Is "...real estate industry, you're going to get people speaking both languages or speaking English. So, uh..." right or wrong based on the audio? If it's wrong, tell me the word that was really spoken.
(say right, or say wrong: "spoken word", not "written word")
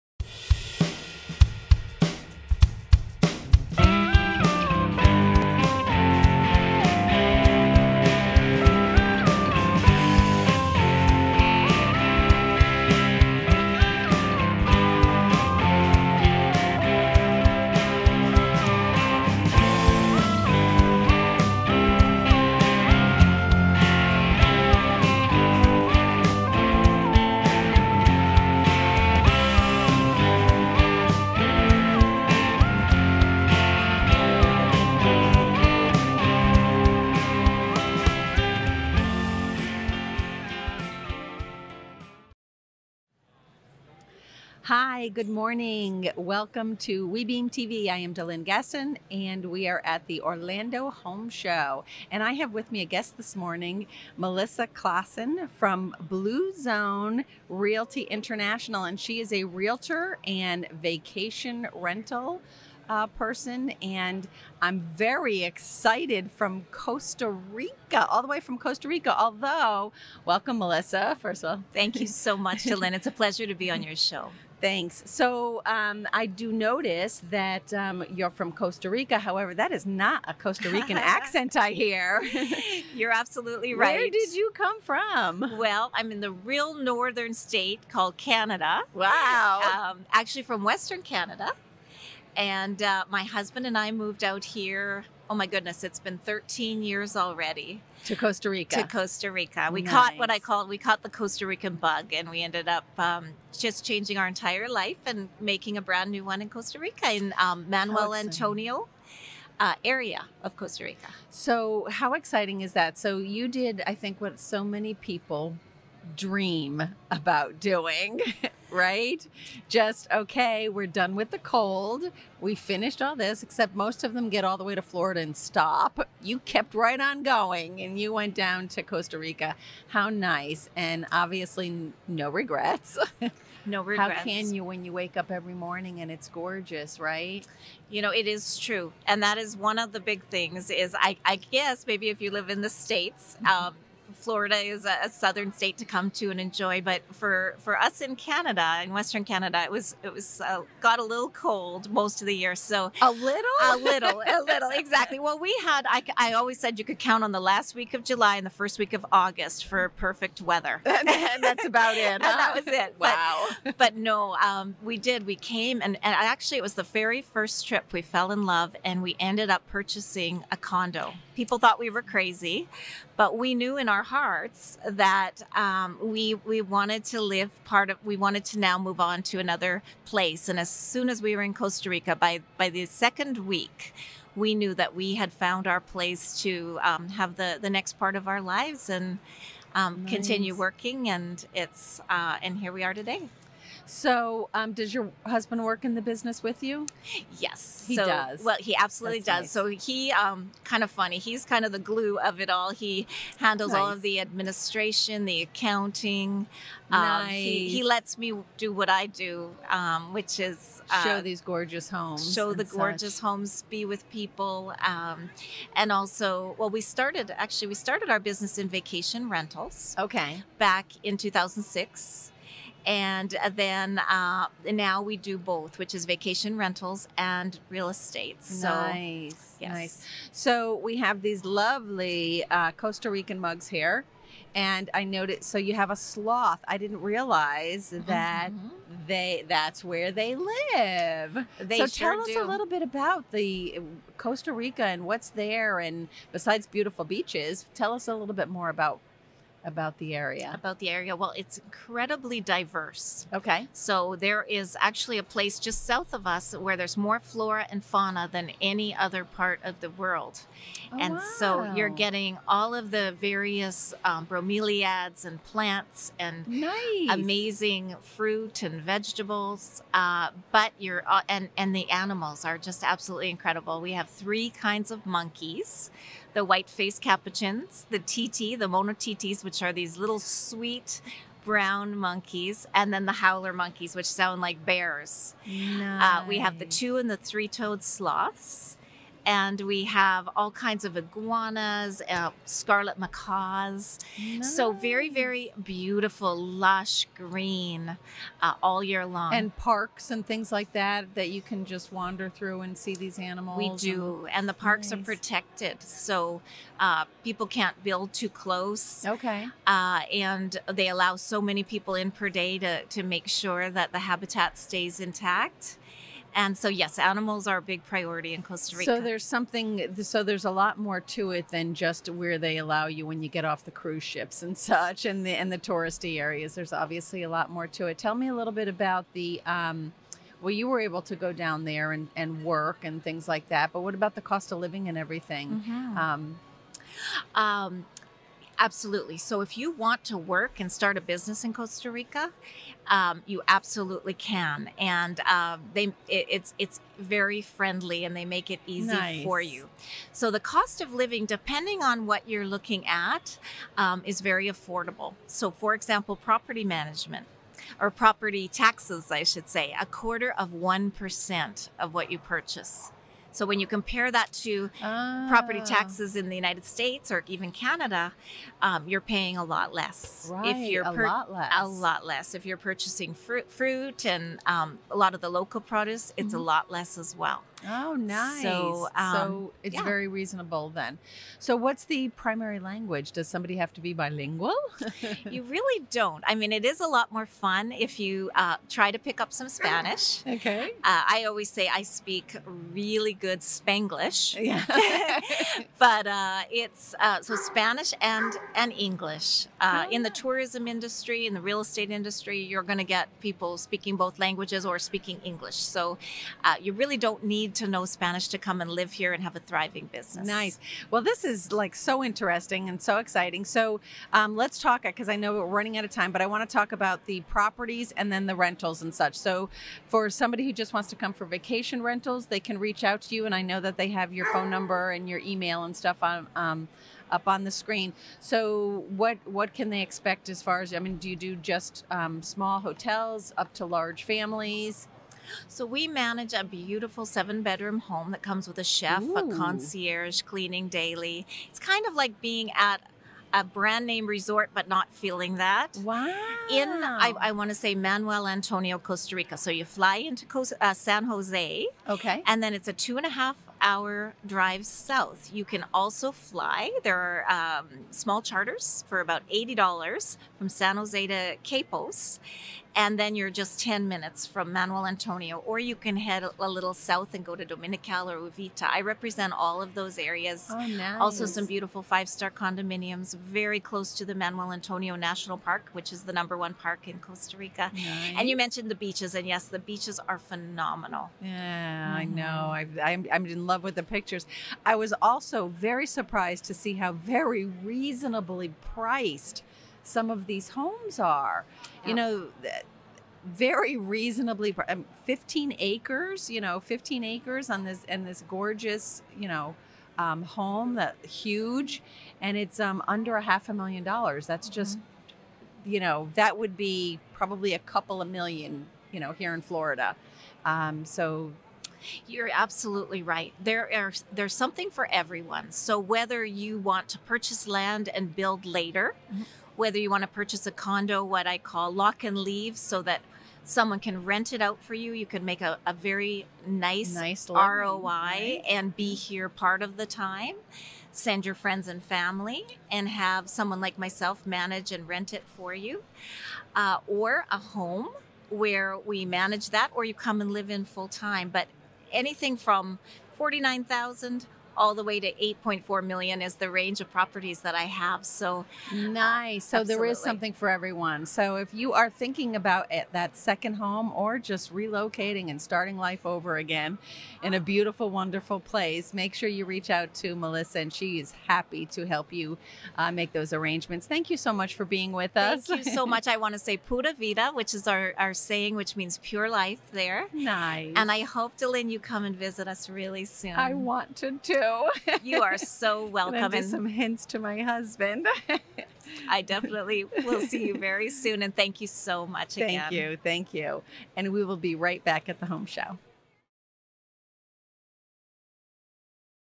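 right.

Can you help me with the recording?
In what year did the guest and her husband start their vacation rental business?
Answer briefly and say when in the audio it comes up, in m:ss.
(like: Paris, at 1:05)
2006, at 3:41.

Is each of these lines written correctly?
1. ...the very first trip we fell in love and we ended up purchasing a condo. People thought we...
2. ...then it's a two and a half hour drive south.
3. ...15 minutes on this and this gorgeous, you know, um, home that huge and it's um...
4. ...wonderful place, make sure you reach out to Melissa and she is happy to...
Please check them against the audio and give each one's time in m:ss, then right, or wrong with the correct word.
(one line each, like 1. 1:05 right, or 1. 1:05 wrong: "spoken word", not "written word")
1. 2:46 right
2. 7:32 right
3. 8:16 wrong: "acres", not "minutes"
4. 9:17 right.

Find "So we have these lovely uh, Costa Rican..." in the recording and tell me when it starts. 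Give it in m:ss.
3:50.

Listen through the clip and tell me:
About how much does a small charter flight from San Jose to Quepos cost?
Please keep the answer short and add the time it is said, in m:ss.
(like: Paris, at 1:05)
$80, at 7:39.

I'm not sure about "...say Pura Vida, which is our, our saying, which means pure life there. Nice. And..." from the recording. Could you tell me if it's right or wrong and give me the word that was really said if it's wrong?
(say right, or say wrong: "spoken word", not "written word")
right.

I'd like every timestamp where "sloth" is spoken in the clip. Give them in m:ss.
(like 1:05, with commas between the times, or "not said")
3:55, 4:47.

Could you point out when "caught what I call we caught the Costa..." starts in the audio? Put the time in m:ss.
1:39.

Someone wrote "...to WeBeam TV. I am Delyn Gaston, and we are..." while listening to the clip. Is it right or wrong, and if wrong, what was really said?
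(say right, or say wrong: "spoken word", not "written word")
right.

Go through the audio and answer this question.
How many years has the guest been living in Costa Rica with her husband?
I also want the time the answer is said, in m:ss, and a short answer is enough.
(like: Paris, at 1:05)
13, at 1:36.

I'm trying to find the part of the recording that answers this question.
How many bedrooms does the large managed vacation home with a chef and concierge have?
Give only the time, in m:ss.
7:17.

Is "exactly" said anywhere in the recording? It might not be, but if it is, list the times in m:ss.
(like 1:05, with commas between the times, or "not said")
2:34.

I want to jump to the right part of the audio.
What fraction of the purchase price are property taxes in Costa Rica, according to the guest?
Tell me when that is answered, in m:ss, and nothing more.
5:59.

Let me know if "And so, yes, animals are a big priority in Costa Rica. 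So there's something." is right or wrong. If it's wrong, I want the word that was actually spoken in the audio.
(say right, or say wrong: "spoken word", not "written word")
right.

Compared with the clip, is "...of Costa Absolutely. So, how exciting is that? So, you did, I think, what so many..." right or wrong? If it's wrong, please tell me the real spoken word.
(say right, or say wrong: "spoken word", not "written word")
wrong: "Rica", not "Absolutely".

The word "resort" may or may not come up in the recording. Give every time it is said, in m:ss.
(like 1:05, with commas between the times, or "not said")
7:24.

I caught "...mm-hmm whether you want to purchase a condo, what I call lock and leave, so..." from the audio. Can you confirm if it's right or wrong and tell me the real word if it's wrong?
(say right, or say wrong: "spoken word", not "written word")
right.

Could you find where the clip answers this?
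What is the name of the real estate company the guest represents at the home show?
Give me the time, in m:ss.
0:55.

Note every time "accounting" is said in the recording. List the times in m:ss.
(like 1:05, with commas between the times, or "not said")
3:25.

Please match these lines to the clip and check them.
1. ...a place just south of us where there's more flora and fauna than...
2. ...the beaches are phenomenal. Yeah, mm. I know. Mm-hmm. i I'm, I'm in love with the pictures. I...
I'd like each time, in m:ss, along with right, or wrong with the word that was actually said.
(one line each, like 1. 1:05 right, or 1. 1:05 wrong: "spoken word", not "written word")
1. 4:15 right
2. 7:59 right.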